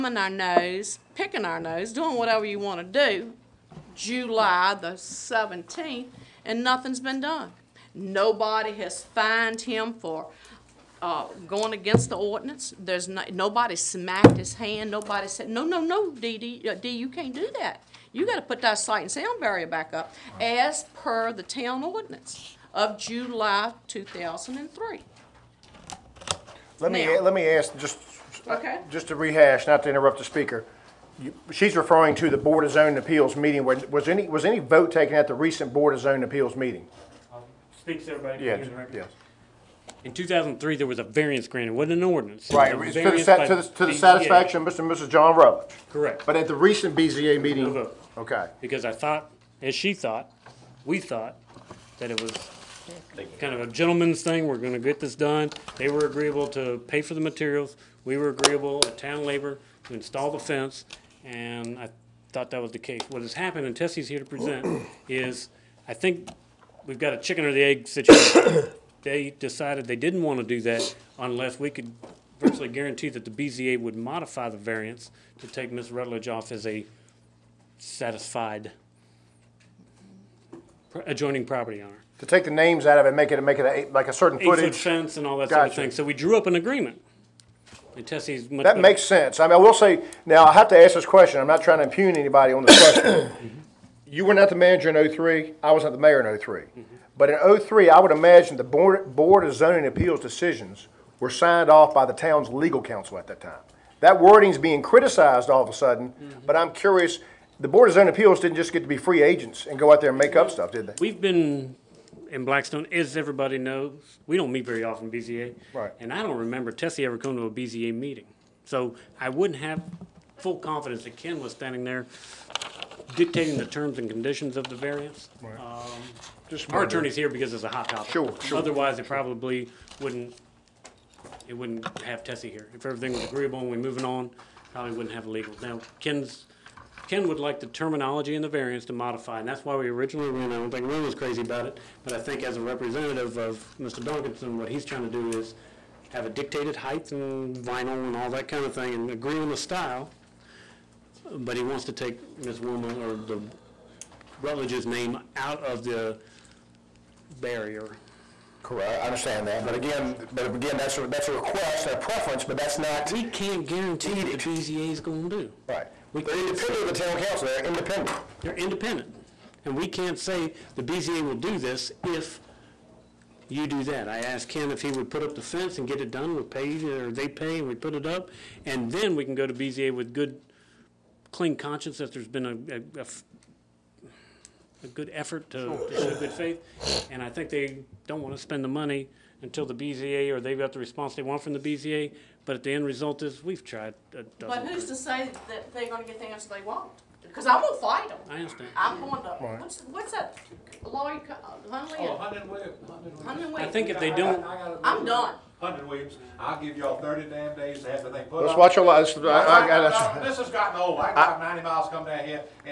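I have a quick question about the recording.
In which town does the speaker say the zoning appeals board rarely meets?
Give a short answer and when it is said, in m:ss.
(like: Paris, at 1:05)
Blackstone, at 1:52.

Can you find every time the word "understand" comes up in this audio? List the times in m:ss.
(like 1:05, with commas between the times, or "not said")
2:39, 3:18.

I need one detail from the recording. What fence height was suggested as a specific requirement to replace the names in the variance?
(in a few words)
8 feet.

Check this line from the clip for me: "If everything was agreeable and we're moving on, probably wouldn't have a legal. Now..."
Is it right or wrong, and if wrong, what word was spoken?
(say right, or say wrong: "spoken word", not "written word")
right.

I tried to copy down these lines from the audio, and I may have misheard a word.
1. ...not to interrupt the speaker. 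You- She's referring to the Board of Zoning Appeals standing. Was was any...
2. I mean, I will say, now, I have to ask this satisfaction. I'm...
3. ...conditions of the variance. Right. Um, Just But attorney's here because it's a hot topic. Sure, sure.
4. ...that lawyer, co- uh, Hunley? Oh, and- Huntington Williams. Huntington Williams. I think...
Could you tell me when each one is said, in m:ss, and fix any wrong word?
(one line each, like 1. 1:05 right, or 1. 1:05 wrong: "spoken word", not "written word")
1. 0:29 wrong: "meeting", not "standing"
2. 1:29 wrong: "question", not "satisfaction"
3. 2:04 wrong: "Our", not "But"
4. 3:20 right.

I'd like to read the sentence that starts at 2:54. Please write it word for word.
I asked Ken if he would put up the fence and get it done.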